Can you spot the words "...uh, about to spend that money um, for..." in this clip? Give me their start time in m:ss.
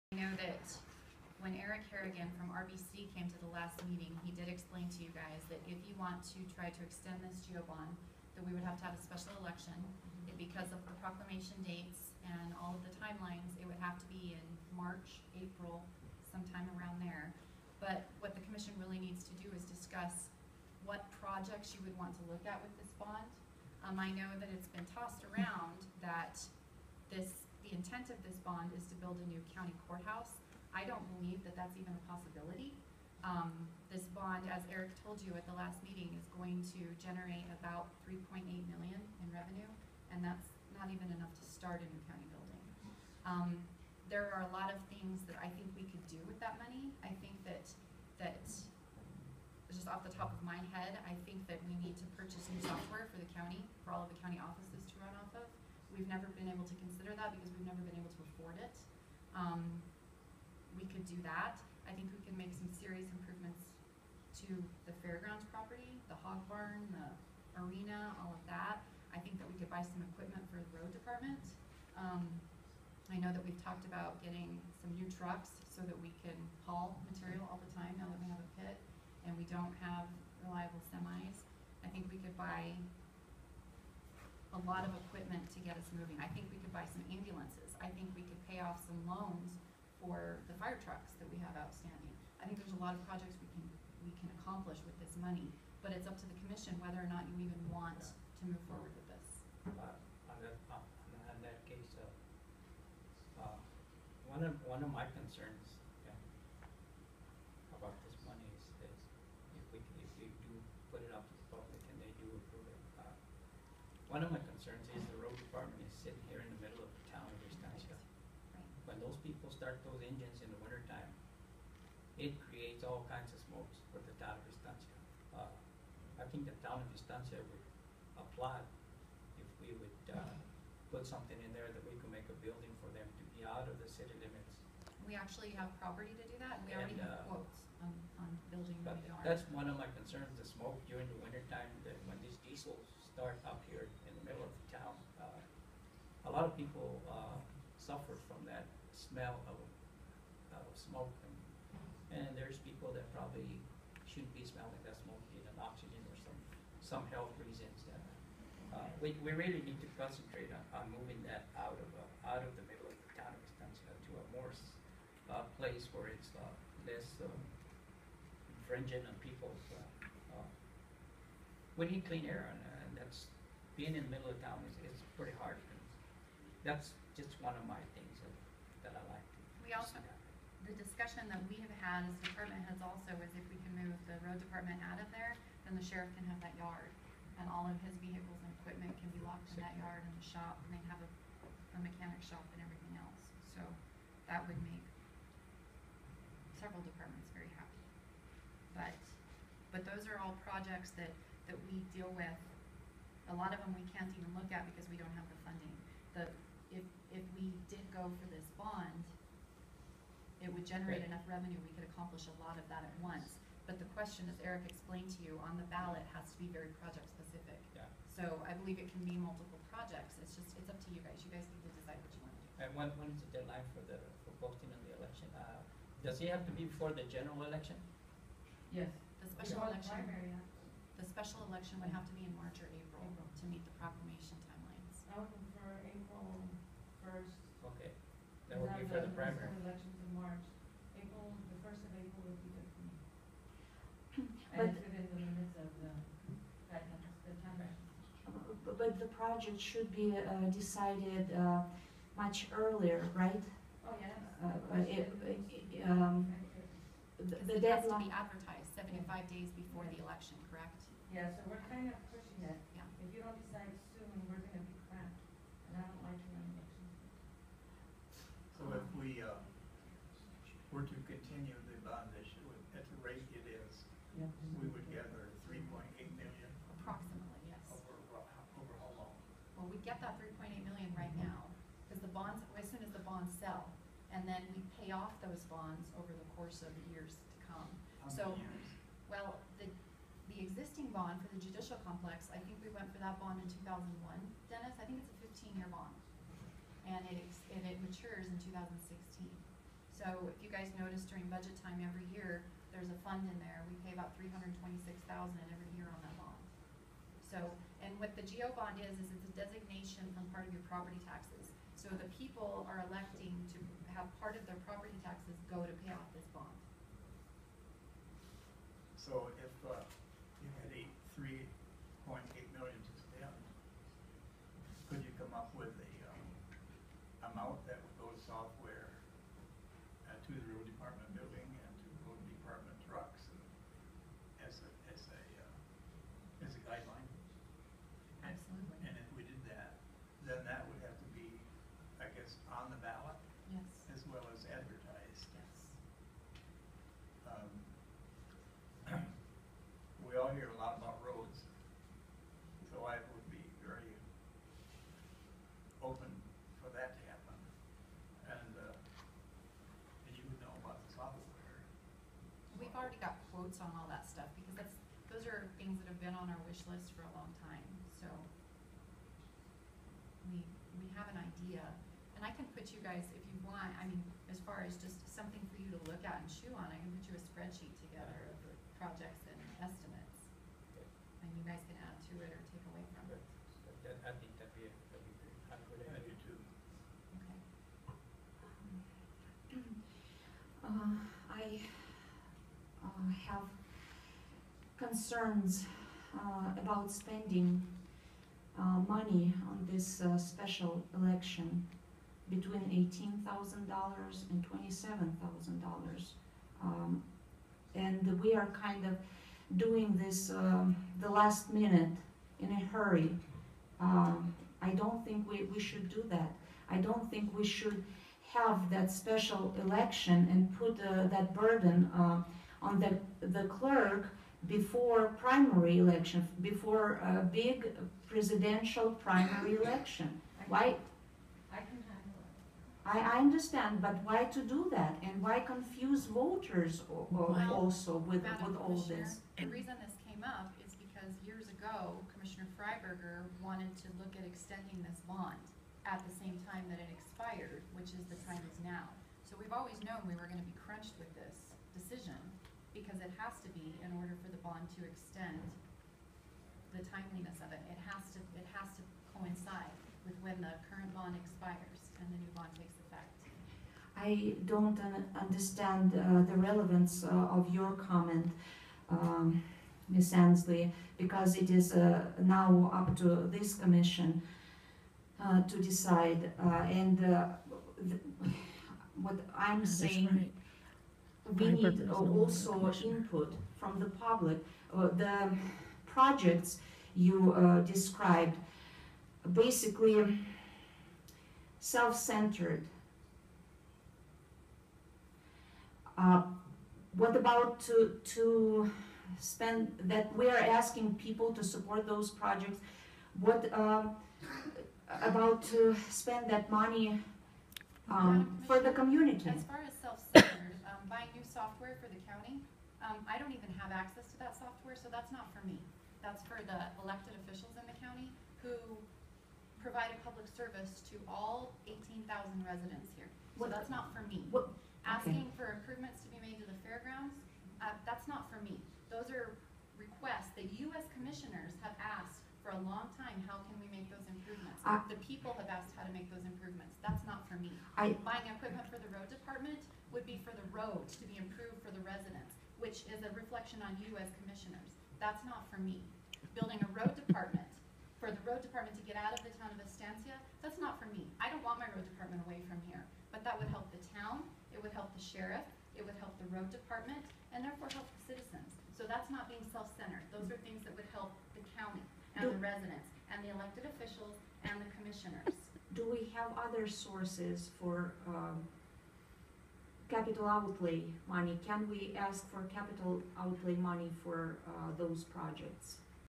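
8:23.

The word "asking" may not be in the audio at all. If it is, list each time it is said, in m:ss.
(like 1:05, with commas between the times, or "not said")
8:20, 8:44.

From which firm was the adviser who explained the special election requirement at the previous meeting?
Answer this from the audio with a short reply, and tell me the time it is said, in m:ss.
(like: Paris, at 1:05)
RBC, at 0:02.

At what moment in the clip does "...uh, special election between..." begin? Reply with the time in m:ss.
6:40.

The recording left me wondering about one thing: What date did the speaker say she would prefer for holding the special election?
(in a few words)
April 1.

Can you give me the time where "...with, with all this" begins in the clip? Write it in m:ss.
7:18.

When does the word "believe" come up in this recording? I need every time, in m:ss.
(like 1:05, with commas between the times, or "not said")
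0:31, 3:38.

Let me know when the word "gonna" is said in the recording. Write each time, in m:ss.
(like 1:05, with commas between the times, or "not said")
4:24, 7:30.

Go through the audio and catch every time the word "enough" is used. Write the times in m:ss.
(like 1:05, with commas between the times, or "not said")
0:41, 3:31.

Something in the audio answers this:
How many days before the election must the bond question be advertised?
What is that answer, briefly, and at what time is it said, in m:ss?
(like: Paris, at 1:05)
75, at 4:18.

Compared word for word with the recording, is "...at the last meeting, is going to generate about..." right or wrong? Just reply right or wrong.
right.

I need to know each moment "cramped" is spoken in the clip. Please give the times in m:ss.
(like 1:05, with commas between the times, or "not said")
4:24.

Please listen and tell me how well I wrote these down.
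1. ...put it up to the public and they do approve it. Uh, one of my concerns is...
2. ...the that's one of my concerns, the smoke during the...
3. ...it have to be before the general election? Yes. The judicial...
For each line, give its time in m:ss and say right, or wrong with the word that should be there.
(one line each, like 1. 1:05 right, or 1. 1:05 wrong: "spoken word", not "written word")
1. 1:50 right
2. 2:19 right
3. 3:46 wrong: "special", not "judicial".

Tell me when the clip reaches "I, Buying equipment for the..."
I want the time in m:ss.
8:57.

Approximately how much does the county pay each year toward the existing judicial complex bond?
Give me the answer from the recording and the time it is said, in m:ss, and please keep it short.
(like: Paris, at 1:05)
326,000, at 5:04.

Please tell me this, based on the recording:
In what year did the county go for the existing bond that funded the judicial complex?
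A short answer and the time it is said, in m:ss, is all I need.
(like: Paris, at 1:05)
2001, at 4:53.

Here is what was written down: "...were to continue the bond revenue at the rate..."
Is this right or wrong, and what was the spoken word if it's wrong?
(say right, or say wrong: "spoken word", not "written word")
wrong: "issue", not "revenue".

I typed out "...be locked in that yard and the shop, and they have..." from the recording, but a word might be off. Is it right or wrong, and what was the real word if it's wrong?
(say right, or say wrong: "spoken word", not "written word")
right.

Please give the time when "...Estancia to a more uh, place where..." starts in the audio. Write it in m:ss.
2:43.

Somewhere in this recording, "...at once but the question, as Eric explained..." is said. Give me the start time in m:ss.
3:32.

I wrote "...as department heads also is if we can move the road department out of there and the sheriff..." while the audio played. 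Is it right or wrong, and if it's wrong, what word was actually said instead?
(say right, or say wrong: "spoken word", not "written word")
right.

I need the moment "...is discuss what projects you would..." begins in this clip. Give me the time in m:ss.
0:19.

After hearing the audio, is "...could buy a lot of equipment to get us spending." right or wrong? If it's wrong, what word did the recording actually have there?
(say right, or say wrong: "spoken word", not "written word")
wrong: "moving", not "spending".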